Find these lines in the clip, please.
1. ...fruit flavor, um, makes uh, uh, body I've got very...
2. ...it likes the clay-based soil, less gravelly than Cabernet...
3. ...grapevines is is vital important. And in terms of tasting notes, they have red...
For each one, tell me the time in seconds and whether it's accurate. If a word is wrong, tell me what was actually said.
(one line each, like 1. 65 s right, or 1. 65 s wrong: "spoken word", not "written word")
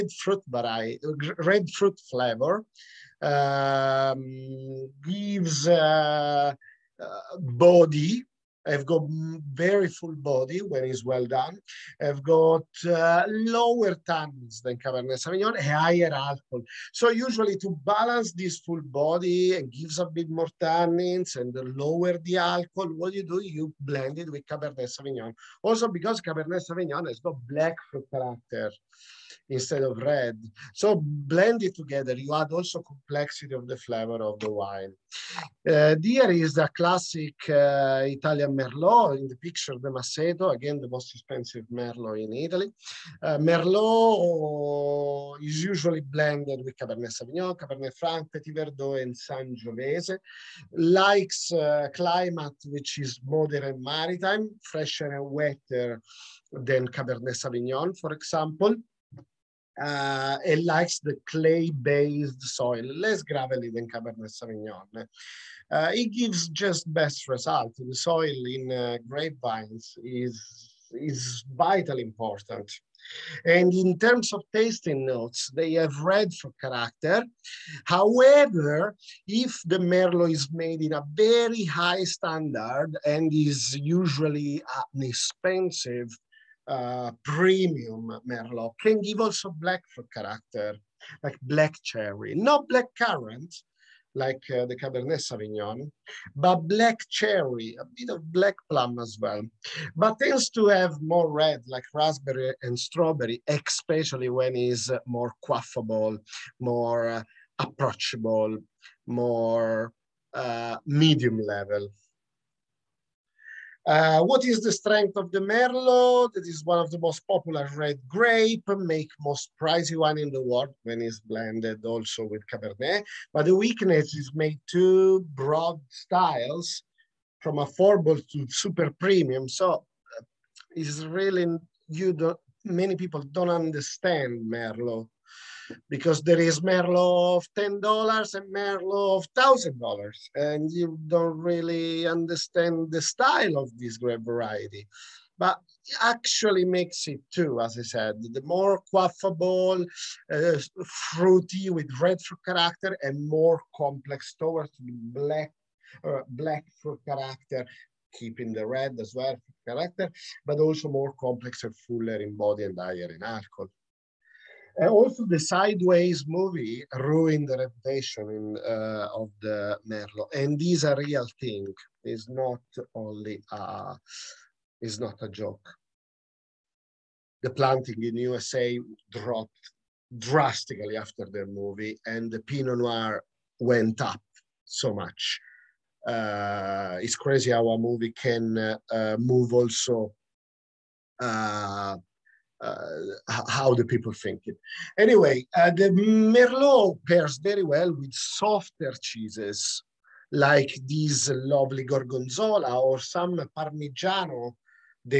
1. 1 s wrong: "gives", not "makes"
2. 60 s right
3. 69 s right.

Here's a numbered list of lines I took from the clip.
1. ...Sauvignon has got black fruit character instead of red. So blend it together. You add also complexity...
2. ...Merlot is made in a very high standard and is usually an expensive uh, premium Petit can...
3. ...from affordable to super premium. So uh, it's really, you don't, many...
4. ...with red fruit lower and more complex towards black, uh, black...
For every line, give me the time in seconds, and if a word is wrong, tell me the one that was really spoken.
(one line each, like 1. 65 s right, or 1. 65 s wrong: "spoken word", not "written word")
1. 26 s right
2. 79 s wrong: "Merlot", not "Petit"
3. 127 s right
4. 151 s wrong: "character", not "lower".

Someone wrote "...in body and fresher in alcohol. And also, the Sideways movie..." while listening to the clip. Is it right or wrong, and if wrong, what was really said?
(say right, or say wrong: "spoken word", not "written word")
wrong: "higher", not "fresher".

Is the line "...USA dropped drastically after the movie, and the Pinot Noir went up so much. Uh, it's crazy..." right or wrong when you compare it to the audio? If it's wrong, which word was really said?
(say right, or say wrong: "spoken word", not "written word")
right.